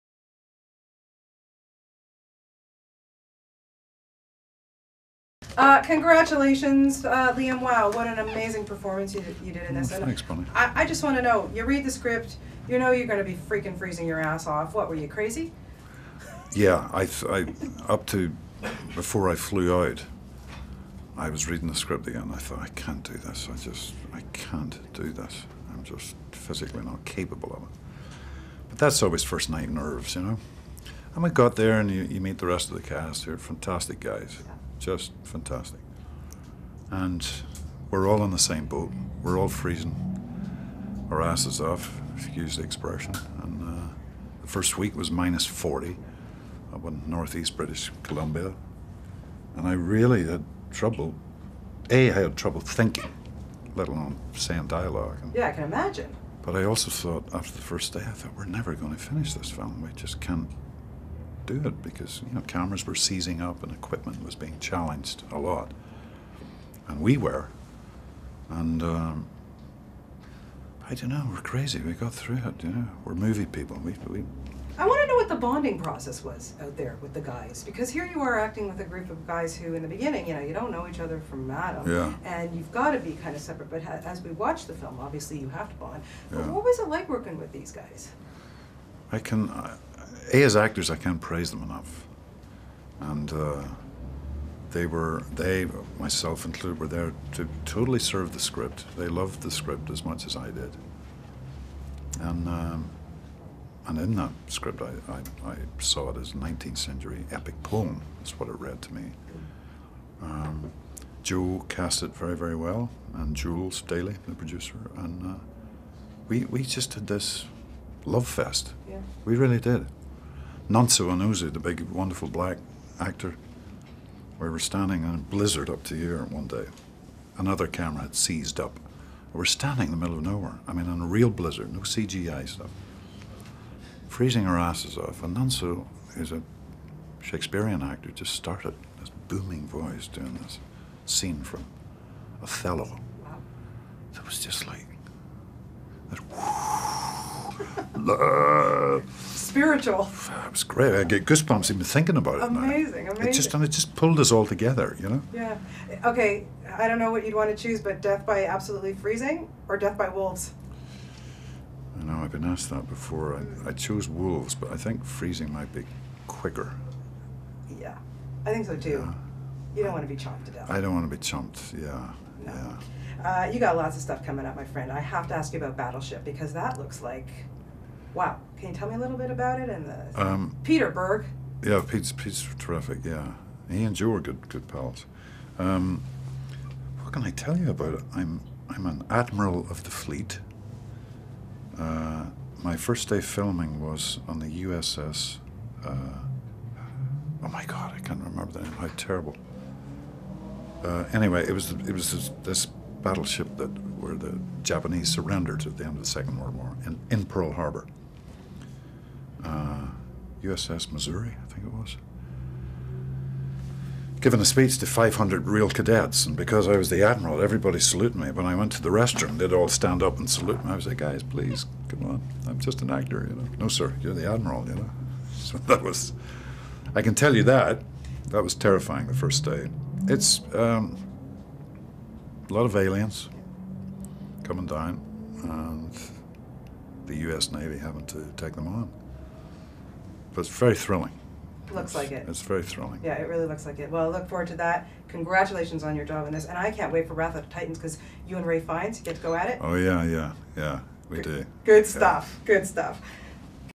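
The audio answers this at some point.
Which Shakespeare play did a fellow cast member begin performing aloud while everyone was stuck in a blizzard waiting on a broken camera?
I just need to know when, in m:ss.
2:22.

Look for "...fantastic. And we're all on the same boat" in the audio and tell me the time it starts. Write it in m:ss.
0:35.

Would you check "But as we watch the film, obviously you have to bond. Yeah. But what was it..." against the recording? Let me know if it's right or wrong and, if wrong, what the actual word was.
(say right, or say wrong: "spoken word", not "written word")
right.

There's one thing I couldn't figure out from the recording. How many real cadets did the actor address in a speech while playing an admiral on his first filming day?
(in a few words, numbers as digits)
500.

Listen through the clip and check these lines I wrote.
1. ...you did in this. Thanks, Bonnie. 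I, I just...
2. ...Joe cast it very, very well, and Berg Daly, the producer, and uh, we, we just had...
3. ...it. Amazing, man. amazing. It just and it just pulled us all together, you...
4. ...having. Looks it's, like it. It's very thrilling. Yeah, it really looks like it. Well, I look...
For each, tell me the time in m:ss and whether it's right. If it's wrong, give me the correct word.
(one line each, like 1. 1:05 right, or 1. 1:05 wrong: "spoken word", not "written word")
1. 0:09 right
2. 1:51 wrong: "Jules", not "Berg"
3. 2:32 right
4. 4:00 wrong: "thrilling", not "having".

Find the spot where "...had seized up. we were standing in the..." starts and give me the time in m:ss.
2:08.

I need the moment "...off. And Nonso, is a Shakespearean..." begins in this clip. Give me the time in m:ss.
2:14.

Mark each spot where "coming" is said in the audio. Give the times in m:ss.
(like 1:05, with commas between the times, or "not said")
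2:54, 3:54.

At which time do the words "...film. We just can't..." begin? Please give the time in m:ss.
0:59.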